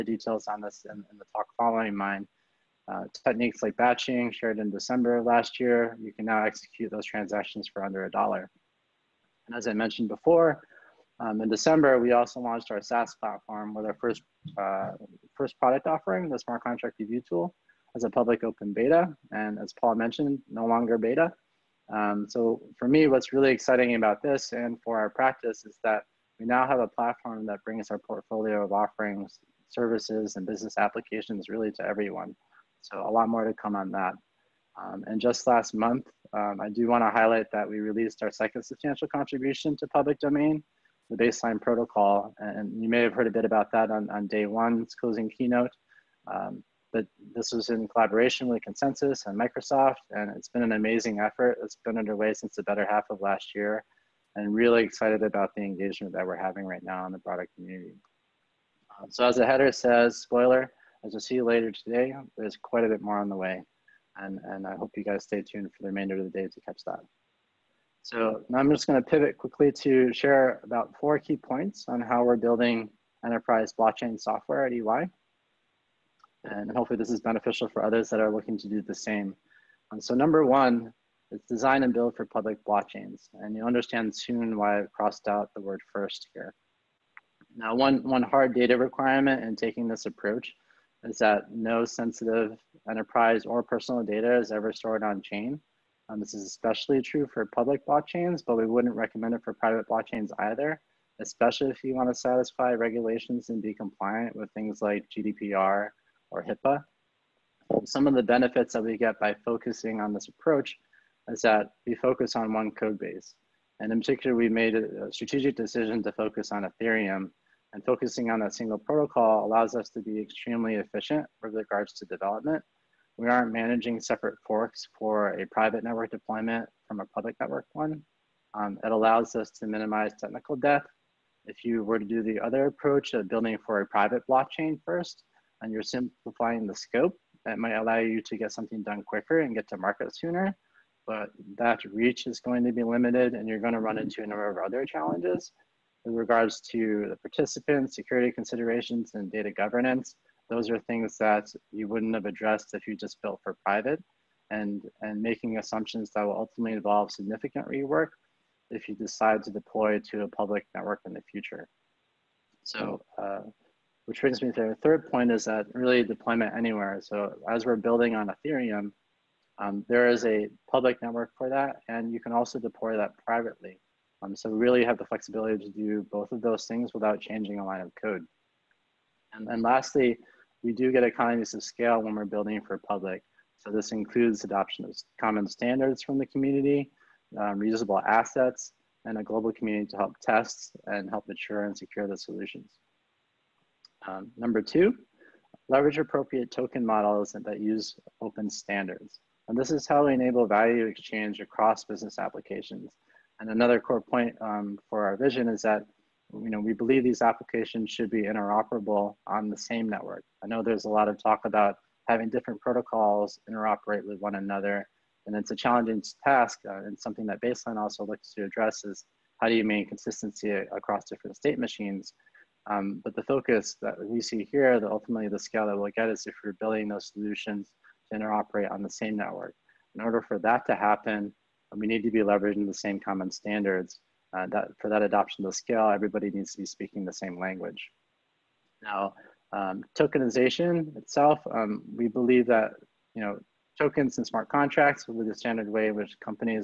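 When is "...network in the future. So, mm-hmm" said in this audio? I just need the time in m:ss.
2:40.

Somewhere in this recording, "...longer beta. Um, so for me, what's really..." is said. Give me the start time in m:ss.
0:20.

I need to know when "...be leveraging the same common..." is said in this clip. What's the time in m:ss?
3:52.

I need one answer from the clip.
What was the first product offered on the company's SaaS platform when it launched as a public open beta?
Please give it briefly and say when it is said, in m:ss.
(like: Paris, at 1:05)
Smart contract review tool, at 0:16.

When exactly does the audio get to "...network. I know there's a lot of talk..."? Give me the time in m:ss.
3:29.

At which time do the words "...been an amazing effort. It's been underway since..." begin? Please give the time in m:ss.
0:50.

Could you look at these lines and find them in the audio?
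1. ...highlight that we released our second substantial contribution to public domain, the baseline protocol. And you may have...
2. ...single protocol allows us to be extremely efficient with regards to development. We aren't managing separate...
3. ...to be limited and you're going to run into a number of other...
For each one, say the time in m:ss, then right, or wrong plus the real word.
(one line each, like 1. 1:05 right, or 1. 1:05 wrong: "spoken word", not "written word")
1. 0:37 right
2. 1:58 right
3. 2:22 right.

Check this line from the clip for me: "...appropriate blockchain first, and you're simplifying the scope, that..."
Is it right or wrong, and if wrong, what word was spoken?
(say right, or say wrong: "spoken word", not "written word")
wrong: "private", not "appropriate".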